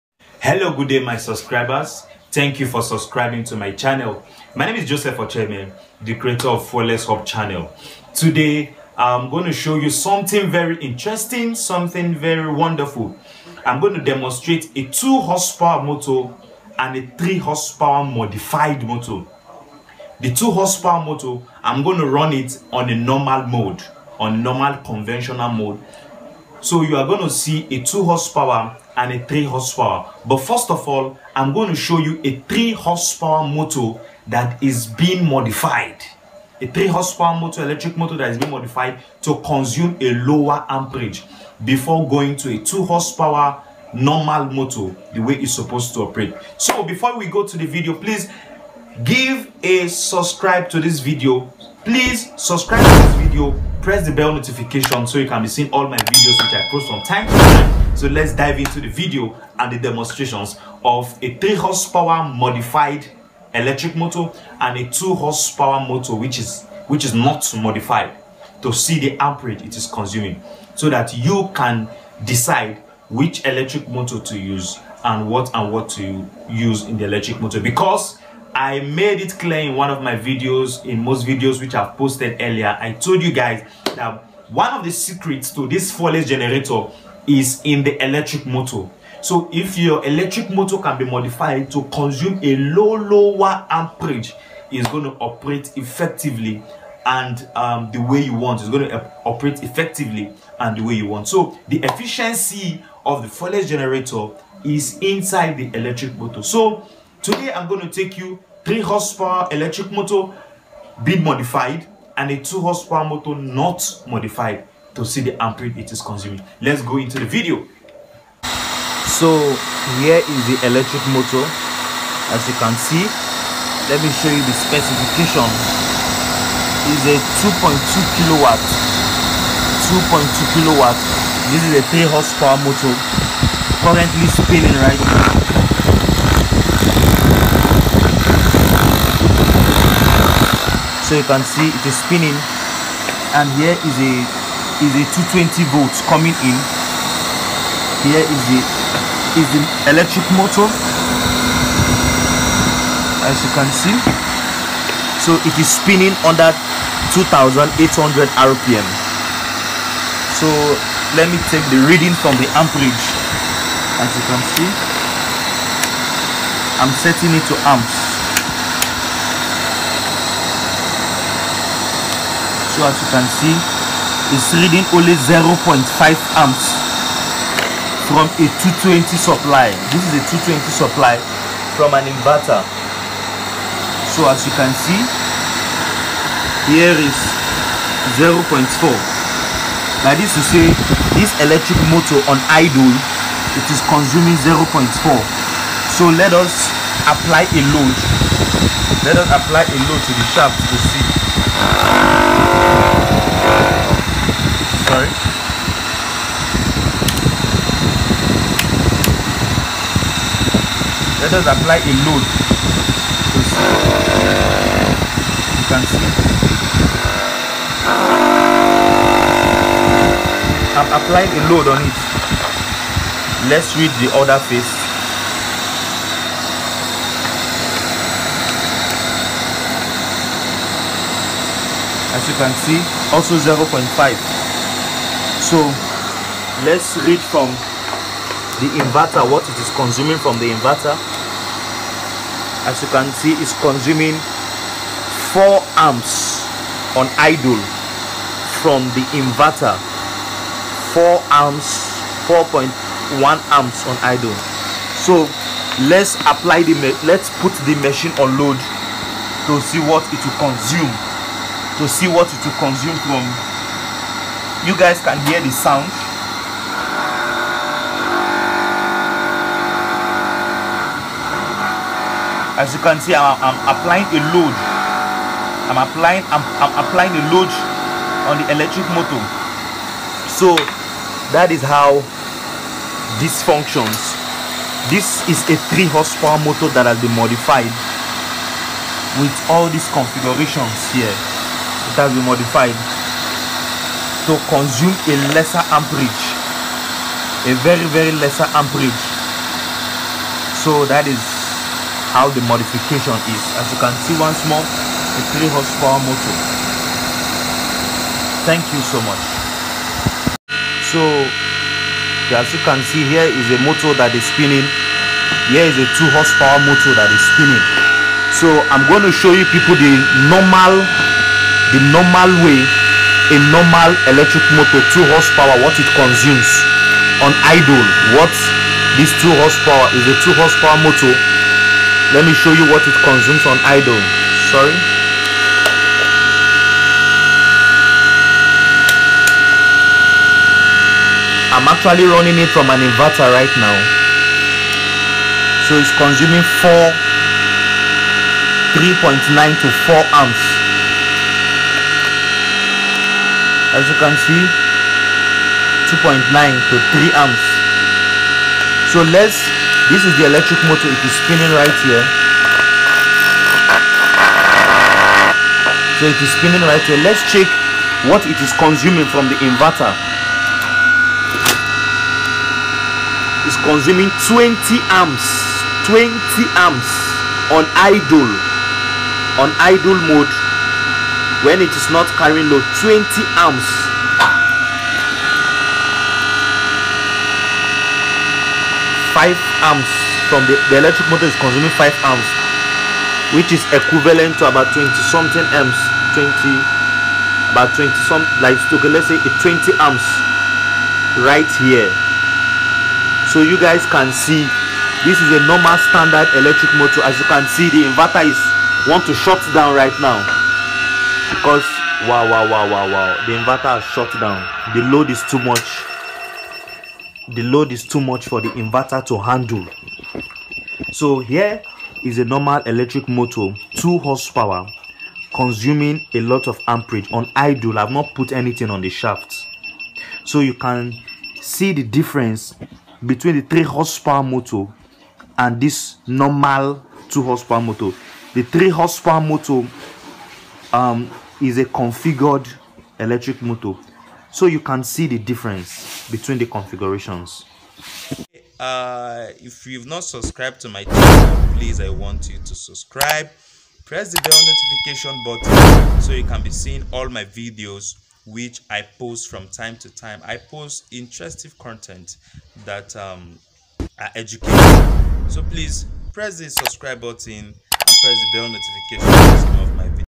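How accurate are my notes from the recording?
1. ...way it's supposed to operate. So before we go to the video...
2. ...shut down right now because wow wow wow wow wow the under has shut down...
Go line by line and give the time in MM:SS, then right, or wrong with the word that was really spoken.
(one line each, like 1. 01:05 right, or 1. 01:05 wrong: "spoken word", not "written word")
1. 00:45 right
2. 06:49 wrong: "inverter", not "under".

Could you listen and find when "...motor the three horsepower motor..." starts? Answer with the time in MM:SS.
07:17.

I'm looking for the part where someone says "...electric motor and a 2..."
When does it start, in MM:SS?
01:03.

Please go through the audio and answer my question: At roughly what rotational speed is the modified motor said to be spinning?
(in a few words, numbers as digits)
2800 rpm.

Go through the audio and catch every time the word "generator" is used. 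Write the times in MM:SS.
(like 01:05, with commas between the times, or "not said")
01:26, 01:43.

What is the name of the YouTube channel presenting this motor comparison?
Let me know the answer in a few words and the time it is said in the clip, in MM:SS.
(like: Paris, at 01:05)
Flawless Hub, at 00:06.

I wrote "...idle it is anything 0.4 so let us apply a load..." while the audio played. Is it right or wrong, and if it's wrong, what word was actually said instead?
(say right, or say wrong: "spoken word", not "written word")
wrong: "consuming", not "anything".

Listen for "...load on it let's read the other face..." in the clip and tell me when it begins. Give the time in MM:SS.
03:41.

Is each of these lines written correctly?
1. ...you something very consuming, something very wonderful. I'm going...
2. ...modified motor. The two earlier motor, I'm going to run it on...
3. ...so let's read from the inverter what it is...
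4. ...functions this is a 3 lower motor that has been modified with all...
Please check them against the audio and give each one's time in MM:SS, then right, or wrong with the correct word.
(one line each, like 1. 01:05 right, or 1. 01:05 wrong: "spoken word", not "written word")
1. 00:09 wrong: "interesting", not "consuming"
2. 00:18 wrong: "horsepower", not "earlier"
3. 03:55 right
4. 04:43 wrong: "horsepower", not "lower".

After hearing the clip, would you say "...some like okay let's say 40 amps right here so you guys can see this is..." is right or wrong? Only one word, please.
wrong.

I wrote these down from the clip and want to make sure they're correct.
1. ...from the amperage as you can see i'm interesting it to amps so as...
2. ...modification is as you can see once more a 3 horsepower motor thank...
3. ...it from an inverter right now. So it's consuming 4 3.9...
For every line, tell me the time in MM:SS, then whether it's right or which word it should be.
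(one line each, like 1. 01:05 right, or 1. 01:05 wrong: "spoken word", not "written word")
1. 02:42 wrong: "setting", not "interesting"
2. 05:02 right
3. 05:42 right.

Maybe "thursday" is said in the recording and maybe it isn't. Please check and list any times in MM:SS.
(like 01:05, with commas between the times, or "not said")
not said.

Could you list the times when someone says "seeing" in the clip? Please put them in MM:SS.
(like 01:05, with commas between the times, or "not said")
00:55, 07:36.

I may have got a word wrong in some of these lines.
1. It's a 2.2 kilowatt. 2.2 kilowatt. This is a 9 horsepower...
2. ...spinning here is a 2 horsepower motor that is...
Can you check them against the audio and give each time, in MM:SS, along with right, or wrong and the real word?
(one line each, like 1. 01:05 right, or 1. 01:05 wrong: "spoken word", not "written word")
1. 02:06 wrong: "3", not "9"
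2. 05:14 right.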